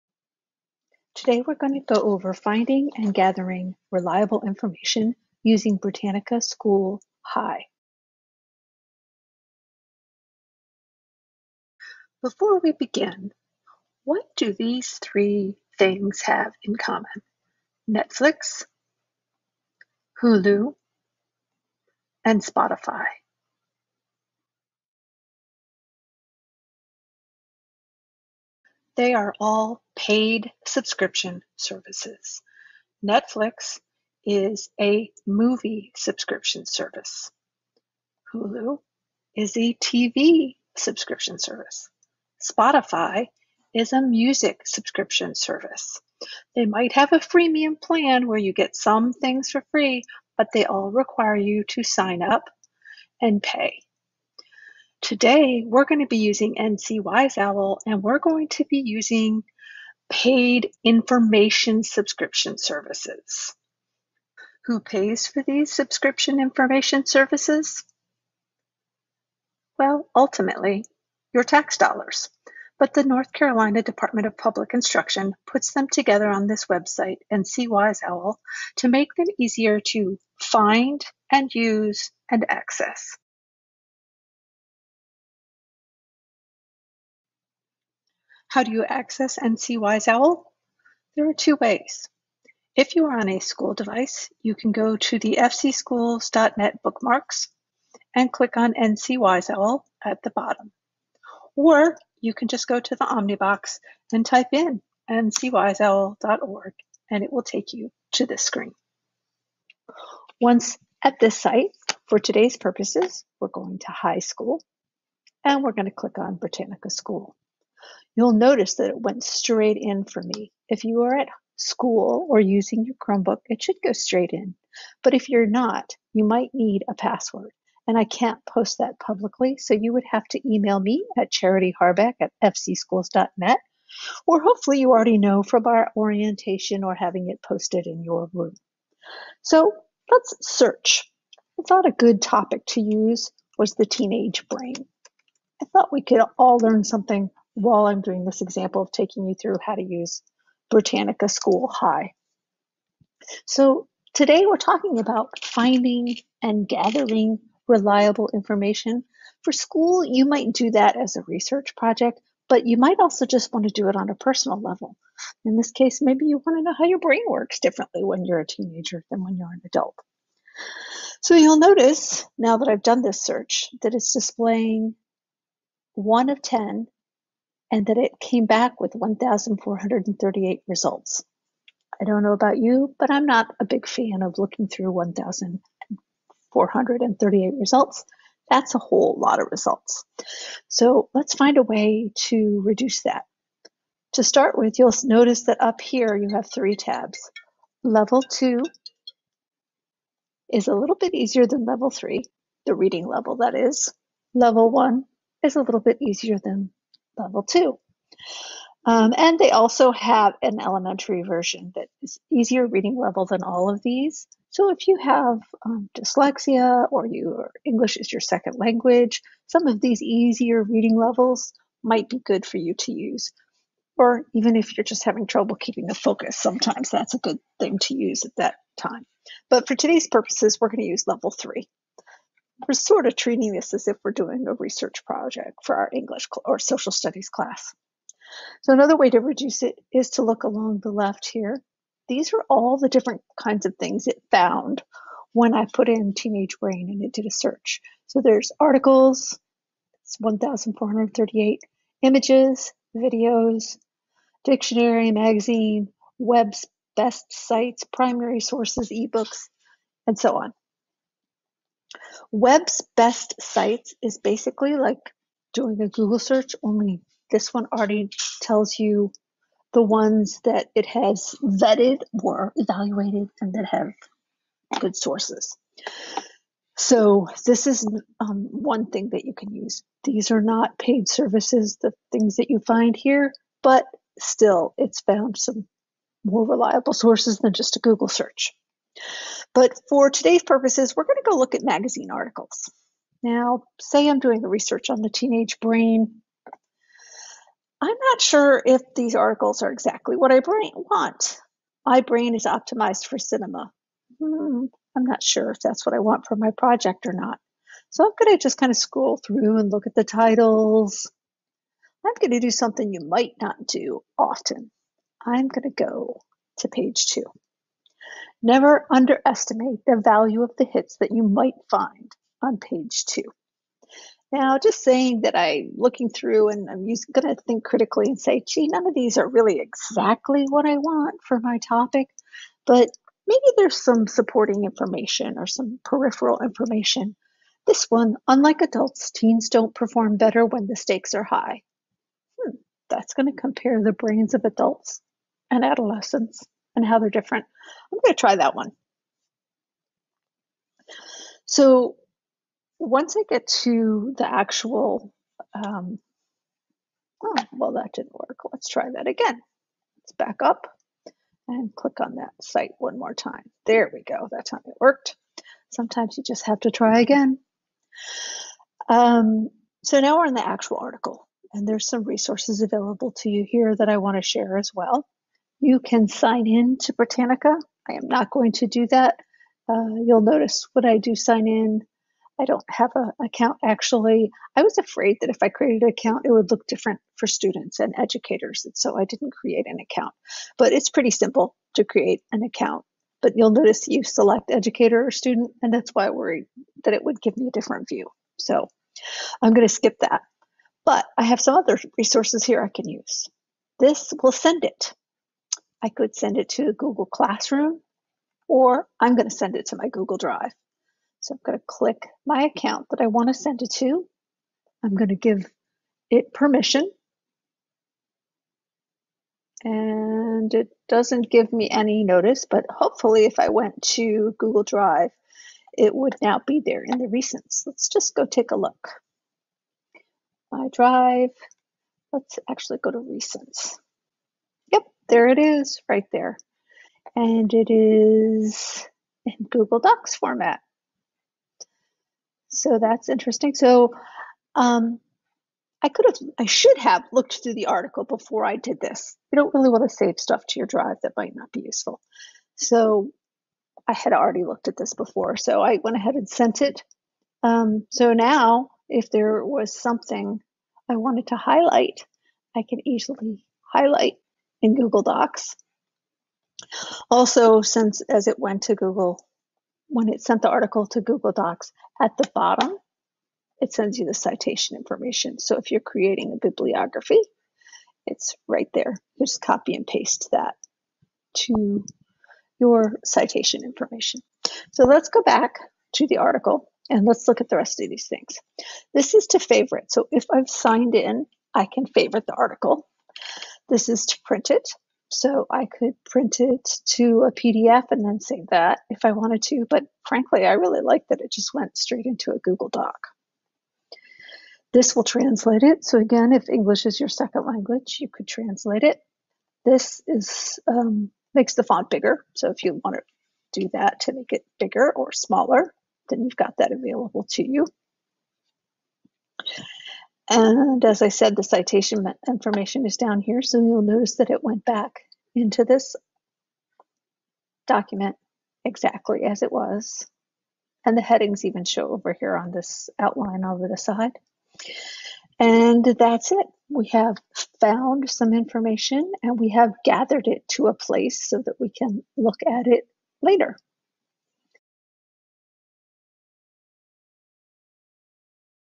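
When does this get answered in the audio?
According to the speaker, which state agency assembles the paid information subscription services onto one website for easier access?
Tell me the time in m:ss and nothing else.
1:13.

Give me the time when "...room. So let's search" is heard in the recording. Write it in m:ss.
2:18.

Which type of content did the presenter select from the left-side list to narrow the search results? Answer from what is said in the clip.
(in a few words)
magazine articles.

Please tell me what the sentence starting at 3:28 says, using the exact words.
Um, and they also have an elementary version that is easier reading level than all of these.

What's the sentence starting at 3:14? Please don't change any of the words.
To start with, you'll notice that up here you have three tabs.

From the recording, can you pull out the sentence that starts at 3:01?
I don't know about you, but I'm not a big fan of looking through 1,438 results.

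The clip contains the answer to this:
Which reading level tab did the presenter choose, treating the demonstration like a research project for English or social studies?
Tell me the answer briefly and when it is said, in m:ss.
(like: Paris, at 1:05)
Level 3, at 3:51.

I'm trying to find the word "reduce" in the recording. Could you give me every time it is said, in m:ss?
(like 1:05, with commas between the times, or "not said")
3:12, 3:59.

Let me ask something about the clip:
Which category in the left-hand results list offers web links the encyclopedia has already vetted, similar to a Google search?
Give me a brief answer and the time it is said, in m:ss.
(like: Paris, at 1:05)
Web's Best Sites, at 4:22.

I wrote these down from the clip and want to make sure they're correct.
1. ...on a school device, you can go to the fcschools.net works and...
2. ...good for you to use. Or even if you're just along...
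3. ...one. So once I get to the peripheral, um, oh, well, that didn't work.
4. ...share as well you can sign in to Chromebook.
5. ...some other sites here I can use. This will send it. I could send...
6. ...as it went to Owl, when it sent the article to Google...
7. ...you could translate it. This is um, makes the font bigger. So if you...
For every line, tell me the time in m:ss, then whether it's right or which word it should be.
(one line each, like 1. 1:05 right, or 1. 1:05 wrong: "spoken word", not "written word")
1. 1:33 wrong: "bookmarks", not "works"
2. 3:42 wrong: "having", not "along"
3. 5:48 wrong: "actual", not "peripheral"
4. 6:14 wrong: "Britannica", not "Chromebook"
5. 6:41 wrong: "resources", not "sites"
6. 7:48 wrong: "Google", not "Owl"
7. 8:27 right.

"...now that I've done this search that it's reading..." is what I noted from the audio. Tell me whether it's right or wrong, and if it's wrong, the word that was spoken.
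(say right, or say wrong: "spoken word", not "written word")
wrong: "displaying", not "reading".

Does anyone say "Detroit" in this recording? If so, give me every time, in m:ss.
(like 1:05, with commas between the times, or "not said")
not said.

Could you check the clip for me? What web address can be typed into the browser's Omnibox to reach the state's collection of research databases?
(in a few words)
ncwiseowl.org.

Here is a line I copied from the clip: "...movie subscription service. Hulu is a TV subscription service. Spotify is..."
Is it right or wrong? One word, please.
right.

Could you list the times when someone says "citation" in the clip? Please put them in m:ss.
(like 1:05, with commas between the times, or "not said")
7:54, 8:03, 8:41.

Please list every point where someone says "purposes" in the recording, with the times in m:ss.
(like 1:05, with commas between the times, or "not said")
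1:52, 3:50, 4:50.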